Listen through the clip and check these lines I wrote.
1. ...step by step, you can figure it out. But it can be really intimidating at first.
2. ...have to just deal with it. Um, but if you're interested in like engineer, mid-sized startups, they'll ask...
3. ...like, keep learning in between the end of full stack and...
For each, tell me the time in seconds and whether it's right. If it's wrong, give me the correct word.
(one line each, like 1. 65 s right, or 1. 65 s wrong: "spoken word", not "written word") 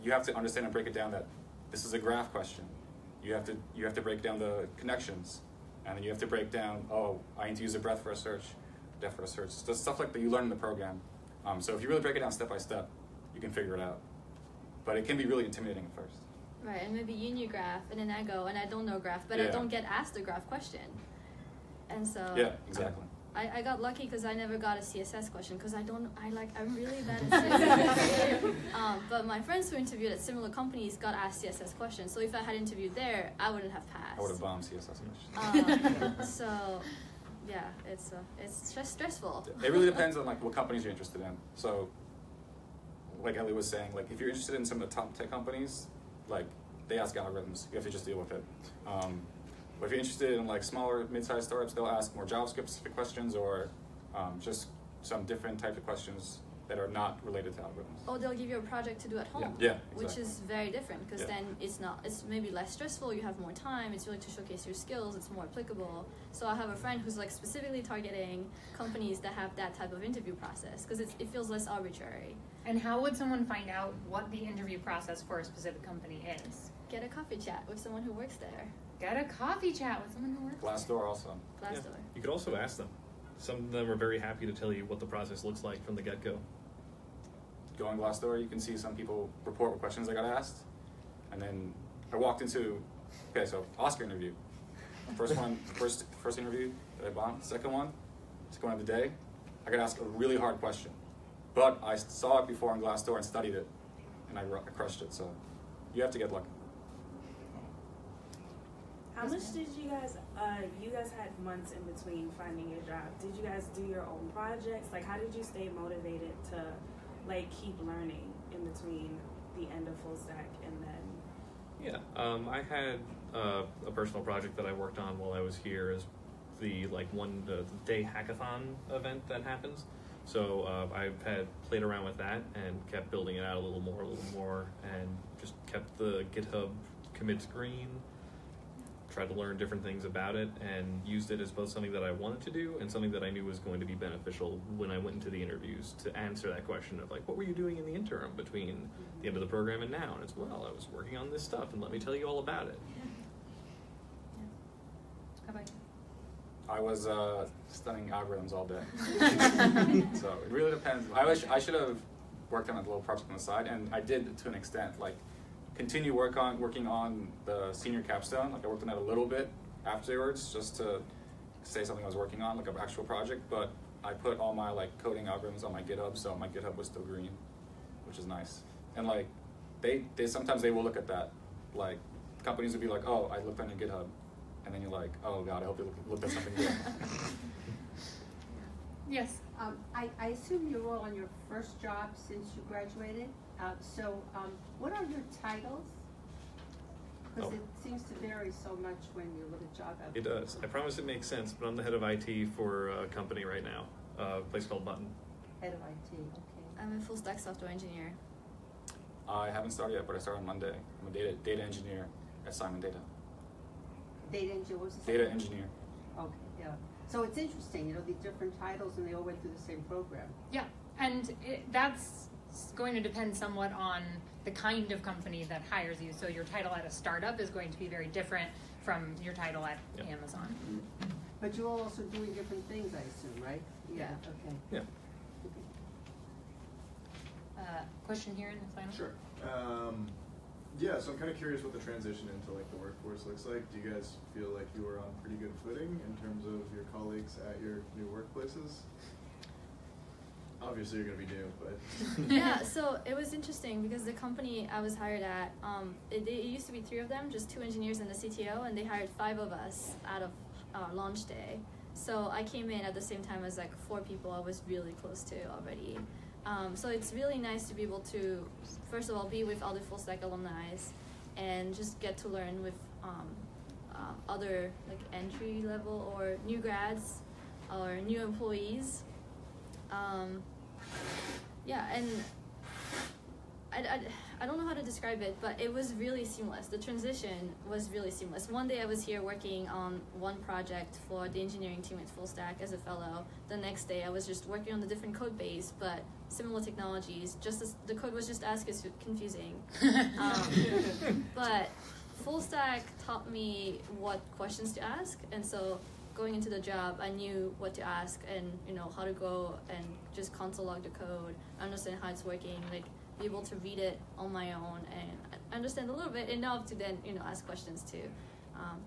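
1. 12 s right
2. 47 s wrong: "smaller", not "engineer"
3. 117 s right.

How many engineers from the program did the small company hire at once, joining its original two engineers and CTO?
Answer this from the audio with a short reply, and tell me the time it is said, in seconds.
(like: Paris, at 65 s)
5, at 259 s.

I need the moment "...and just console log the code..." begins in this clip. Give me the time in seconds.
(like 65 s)
309 s.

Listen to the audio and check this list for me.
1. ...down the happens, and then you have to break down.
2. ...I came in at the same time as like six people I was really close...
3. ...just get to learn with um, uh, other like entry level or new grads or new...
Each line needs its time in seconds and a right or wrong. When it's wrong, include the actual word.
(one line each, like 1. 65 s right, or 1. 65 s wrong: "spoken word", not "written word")
1. 4 s wrong: "connections", not "happens"
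2. 262 s wrong: "four", not "six"
3. 271 s right.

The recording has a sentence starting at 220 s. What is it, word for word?
Yeah, and it, that's going to depend somewhat on the kind of company that hires you.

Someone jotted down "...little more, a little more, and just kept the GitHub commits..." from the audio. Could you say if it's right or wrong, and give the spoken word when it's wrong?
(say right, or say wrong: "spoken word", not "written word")
right.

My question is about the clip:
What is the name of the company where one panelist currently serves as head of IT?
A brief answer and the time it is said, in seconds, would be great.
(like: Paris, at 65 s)
Button, at 204 s.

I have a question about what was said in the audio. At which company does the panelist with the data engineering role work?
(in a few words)
Simon Data.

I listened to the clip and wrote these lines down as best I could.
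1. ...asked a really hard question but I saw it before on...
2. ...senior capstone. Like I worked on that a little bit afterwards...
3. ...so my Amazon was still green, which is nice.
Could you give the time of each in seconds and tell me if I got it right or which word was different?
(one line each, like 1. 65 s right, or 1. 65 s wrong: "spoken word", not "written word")
1. 99 s right
2. 167 s right
3. 176 s wrong: "GitHub", not "Amazon".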